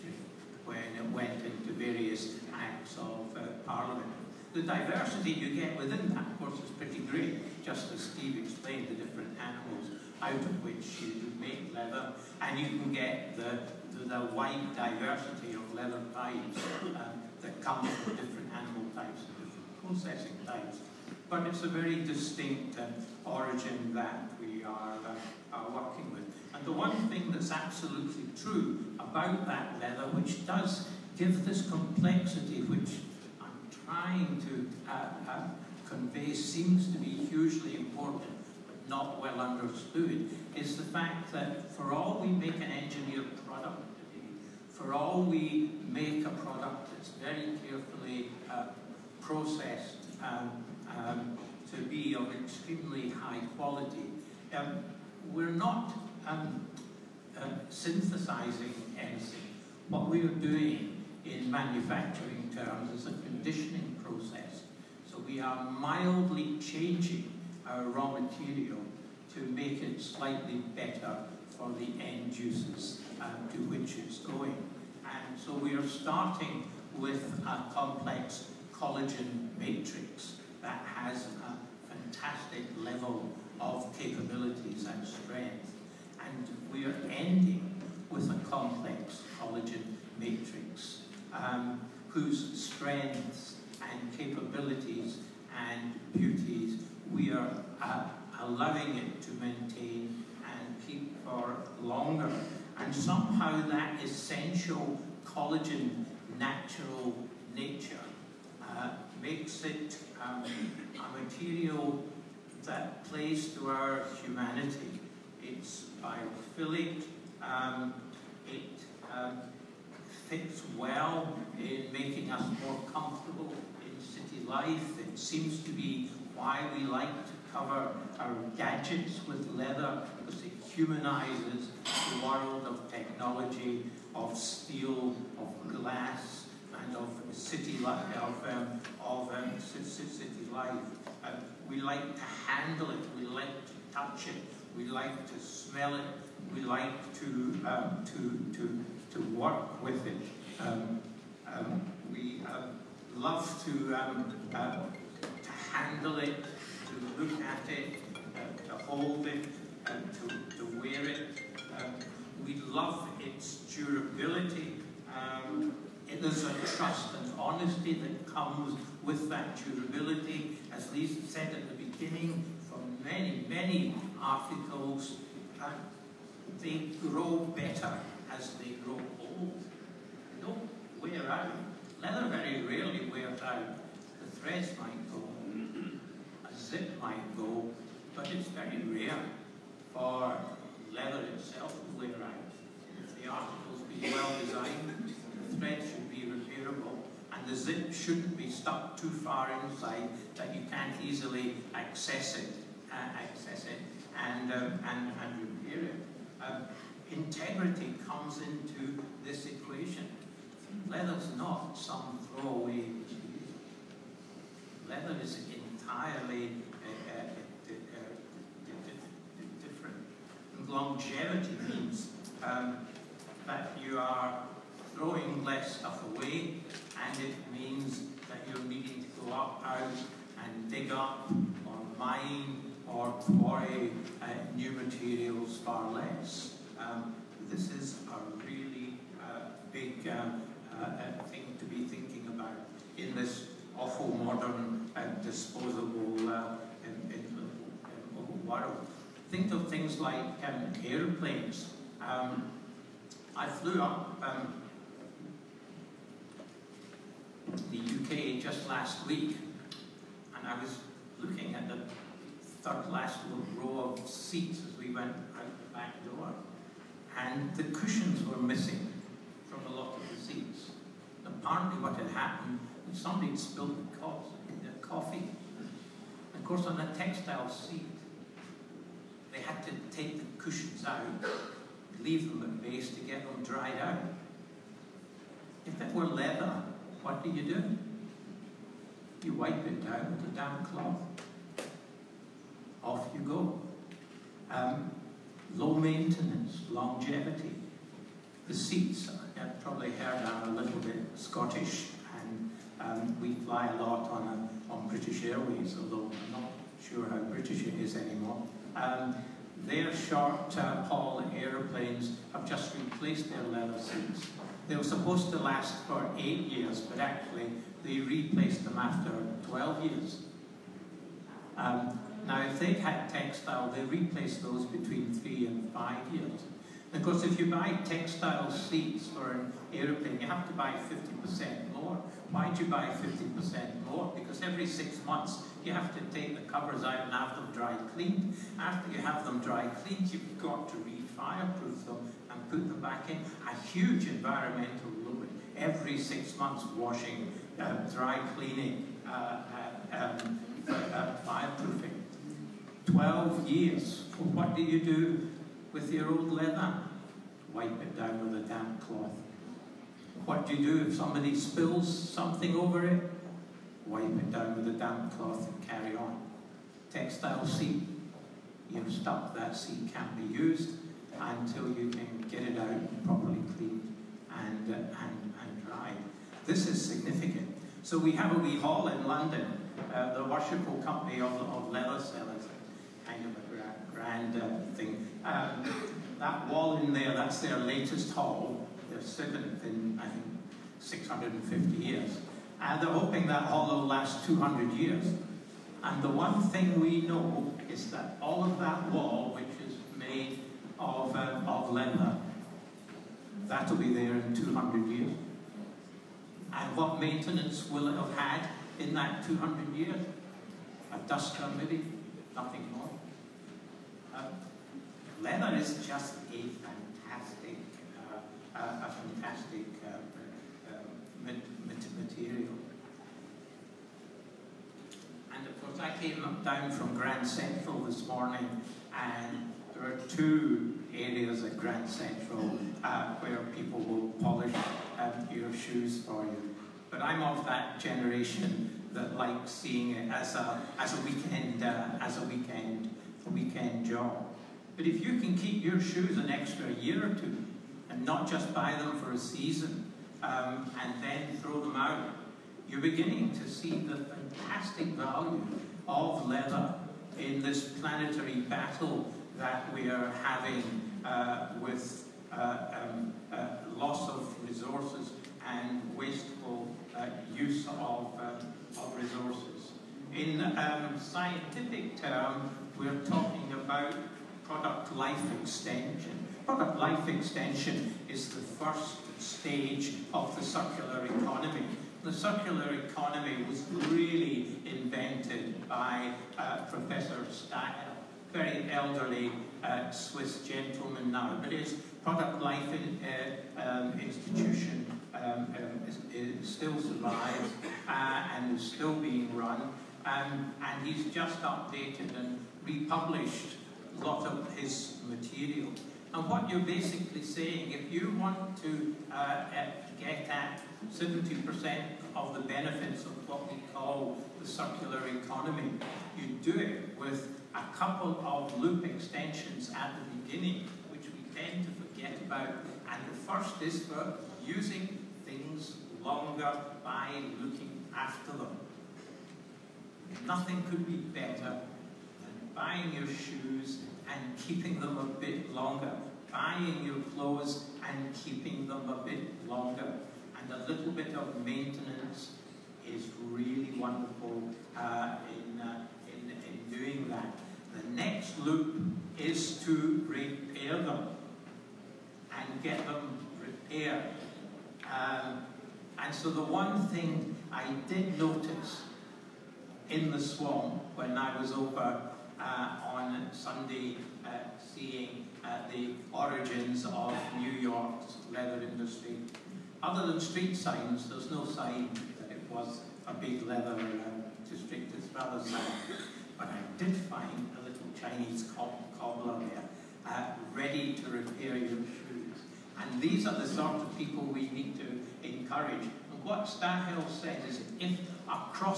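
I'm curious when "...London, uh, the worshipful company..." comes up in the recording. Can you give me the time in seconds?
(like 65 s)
379 s.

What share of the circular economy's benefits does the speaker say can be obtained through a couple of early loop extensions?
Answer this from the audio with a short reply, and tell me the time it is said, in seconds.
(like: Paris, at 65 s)
70%, at 510 s.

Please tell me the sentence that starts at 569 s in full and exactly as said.
Other than street signs, there's no sign that it was a big leather district, uh, district, it's rather sad.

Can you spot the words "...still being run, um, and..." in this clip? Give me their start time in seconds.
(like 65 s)
498 s.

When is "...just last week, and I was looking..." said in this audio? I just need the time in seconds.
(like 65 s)
258 s.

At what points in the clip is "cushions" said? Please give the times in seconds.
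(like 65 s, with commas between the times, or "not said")
267 s, 280 s.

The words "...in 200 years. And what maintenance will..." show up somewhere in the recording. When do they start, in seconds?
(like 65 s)
404 s.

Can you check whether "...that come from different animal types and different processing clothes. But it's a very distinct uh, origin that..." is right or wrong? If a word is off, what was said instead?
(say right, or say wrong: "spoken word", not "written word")
wrong: "types", not "clothes".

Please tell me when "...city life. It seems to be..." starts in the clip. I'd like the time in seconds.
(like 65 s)
124 s.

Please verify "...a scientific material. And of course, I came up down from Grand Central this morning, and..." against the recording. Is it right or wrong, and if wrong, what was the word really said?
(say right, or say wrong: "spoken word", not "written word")
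wrong: "fantastic", not "scientific".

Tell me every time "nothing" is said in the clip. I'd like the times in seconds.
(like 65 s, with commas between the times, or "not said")
412 s, 530 s.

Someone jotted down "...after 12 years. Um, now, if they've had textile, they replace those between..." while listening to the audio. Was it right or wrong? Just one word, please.
right.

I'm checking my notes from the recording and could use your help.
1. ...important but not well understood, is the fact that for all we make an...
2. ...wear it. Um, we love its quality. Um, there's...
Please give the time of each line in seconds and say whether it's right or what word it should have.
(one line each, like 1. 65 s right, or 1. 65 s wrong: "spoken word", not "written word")
1. 37 s right
2. 160 s wrong: "durability", not "quality".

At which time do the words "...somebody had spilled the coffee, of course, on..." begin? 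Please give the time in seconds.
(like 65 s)
273 s.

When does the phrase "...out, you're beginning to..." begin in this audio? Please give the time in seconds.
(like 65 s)
451 s.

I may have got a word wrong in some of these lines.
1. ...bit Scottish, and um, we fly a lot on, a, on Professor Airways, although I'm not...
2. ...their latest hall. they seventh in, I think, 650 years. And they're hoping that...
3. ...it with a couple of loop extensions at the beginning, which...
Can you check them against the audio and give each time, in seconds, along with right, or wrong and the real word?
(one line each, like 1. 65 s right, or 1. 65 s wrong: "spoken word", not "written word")
1. 300 s wrong: "British", not "Professor"
2. 387 s right
3. 516 s right.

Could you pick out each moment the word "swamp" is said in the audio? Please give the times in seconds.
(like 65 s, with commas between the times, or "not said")
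560 s.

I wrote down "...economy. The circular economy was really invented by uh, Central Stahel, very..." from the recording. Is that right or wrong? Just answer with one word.
wrong.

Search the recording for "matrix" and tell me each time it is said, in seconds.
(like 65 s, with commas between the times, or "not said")
79 s, 90 s.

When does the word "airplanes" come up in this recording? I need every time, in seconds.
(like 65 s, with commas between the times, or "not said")
250 s, 311 s.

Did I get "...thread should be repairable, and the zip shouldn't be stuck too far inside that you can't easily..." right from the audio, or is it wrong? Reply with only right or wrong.
right.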